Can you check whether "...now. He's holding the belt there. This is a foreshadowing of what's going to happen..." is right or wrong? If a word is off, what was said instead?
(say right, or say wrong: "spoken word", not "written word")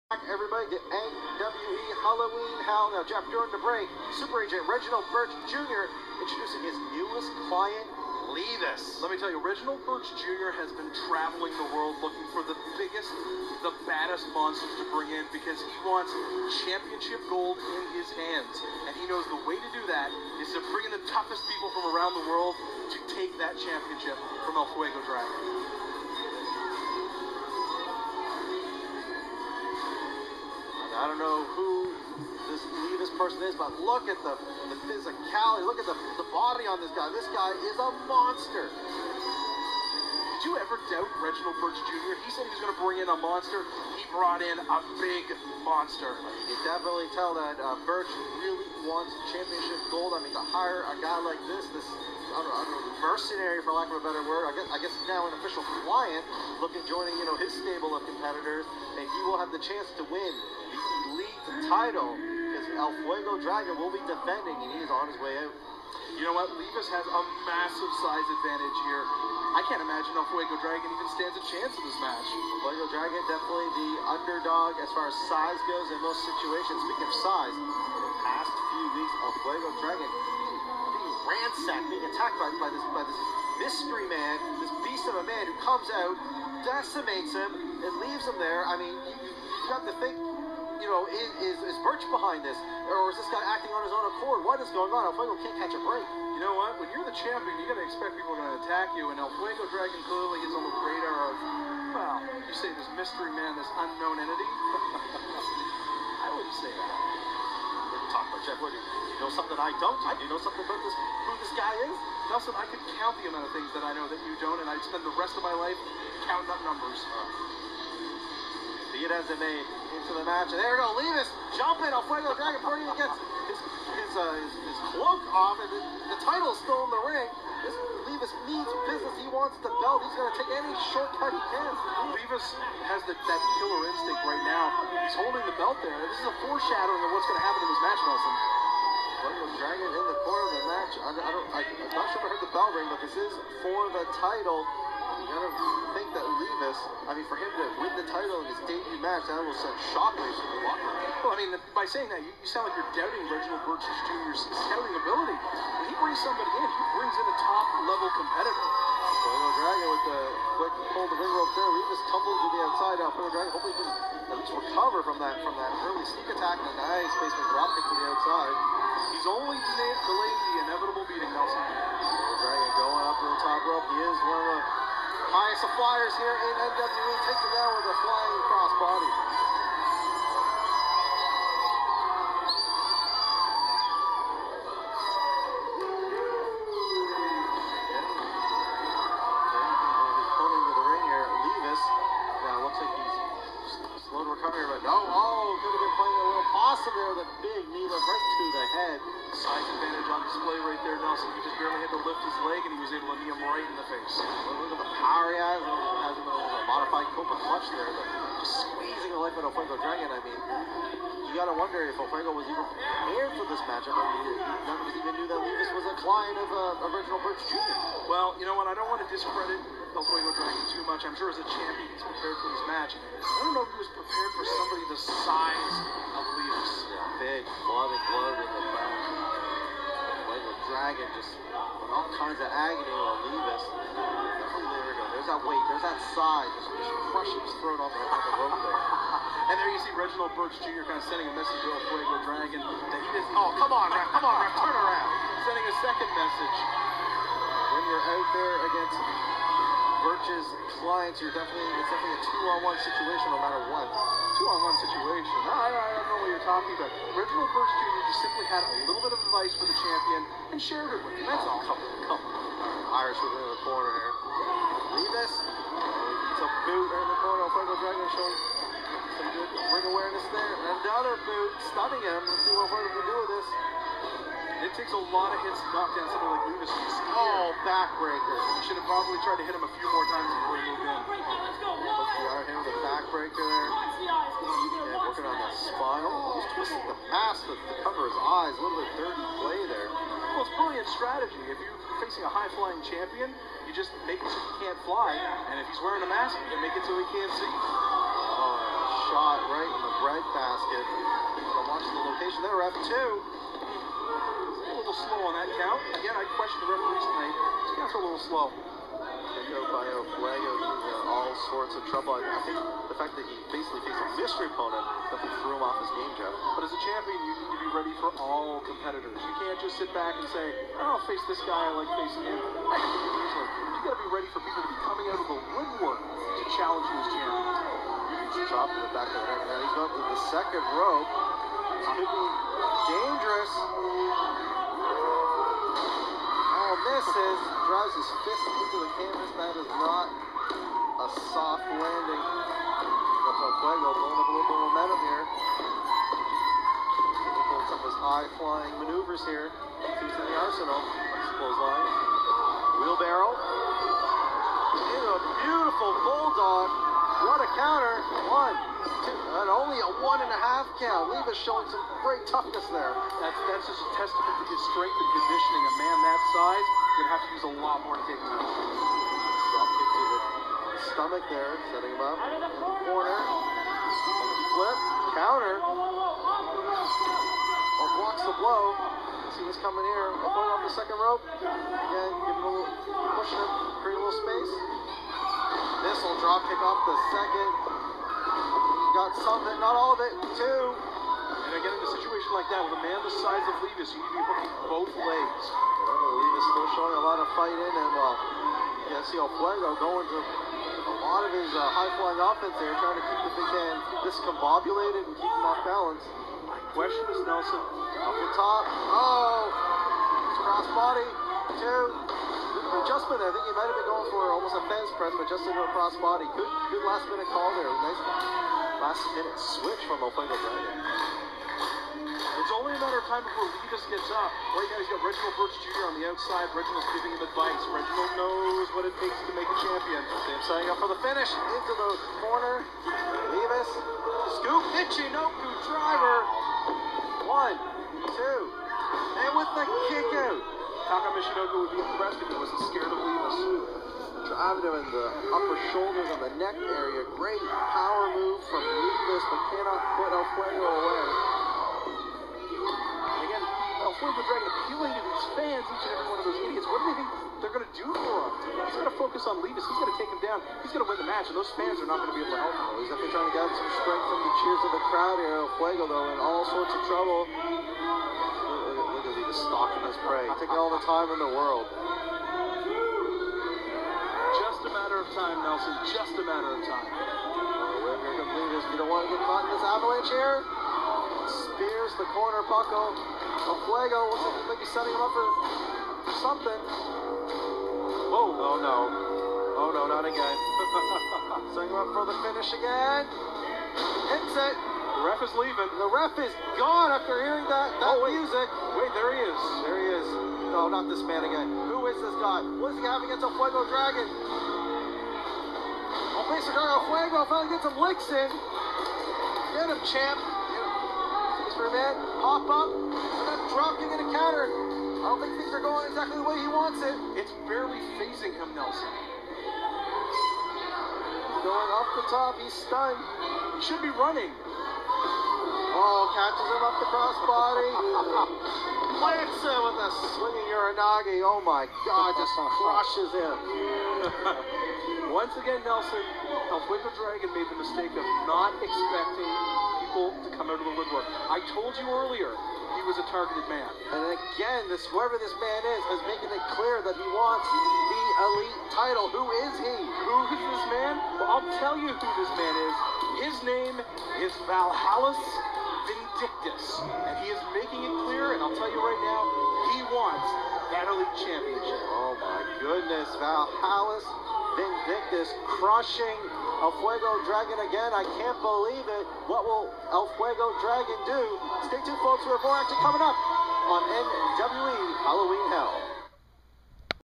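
right.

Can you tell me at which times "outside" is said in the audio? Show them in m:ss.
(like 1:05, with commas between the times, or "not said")
2:42, 2:48, 7:06.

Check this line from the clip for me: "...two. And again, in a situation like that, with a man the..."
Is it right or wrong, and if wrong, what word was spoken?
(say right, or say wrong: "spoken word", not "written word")
right.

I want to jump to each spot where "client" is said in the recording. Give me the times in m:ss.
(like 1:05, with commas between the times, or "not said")
0:07, 0:55, 3:36, 4:10.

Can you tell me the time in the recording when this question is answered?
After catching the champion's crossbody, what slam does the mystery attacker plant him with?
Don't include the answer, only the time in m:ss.
8:50.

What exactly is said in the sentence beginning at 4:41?
Yeah, but the backbreaker working on the spinal.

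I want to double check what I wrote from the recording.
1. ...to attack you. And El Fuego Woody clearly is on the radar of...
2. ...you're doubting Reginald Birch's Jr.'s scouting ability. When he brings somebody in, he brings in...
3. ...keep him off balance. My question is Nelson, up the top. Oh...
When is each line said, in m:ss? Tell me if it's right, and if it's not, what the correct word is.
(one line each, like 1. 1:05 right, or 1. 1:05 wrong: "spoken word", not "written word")
1. 1:38 wrong: "Dragon", not "Woody"
2. 2:32 right
3. 6:45 right.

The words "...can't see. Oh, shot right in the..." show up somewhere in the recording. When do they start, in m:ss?
4:57.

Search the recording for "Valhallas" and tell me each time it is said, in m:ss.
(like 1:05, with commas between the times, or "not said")
9:14, 9:23.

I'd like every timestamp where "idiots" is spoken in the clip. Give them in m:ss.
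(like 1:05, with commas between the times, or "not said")
7:36.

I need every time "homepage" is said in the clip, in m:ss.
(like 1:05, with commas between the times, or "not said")
not said.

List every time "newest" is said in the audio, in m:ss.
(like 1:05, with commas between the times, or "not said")
0:06.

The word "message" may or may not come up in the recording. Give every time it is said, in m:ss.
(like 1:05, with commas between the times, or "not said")
4:01, 4:06.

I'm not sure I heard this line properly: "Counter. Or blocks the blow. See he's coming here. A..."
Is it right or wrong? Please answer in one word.
right.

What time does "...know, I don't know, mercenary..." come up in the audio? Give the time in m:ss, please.
0:52.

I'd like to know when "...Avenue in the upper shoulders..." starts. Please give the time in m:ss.
7:24.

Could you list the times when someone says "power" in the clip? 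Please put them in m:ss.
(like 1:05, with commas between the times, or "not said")
3:24, 7:27.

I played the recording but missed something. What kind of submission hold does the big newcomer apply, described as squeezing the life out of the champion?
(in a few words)
Modified cobra clutch.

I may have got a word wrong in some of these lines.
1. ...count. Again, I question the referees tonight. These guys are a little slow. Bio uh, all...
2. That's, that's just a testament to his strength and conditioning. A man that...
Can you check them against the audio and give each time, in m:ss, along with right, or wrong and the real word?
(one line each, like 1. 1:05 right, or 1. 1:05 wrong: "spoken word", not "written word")
1. 5:05 right
2. 6:03 right.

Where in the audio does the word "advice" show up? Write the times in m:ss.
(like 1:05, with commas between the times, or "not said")
4:19, 7:07.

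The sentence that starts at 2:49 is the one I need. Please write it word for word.
He's only delayed, the inevitable beating, Nelson.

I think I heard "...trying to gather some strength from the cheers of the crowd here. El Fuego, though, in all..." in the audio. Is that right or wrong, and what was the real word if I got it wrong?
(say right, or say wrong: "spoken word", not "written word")
right.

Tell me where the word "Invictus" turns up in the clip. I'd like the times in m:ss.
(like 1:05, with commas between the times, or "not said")
9:24.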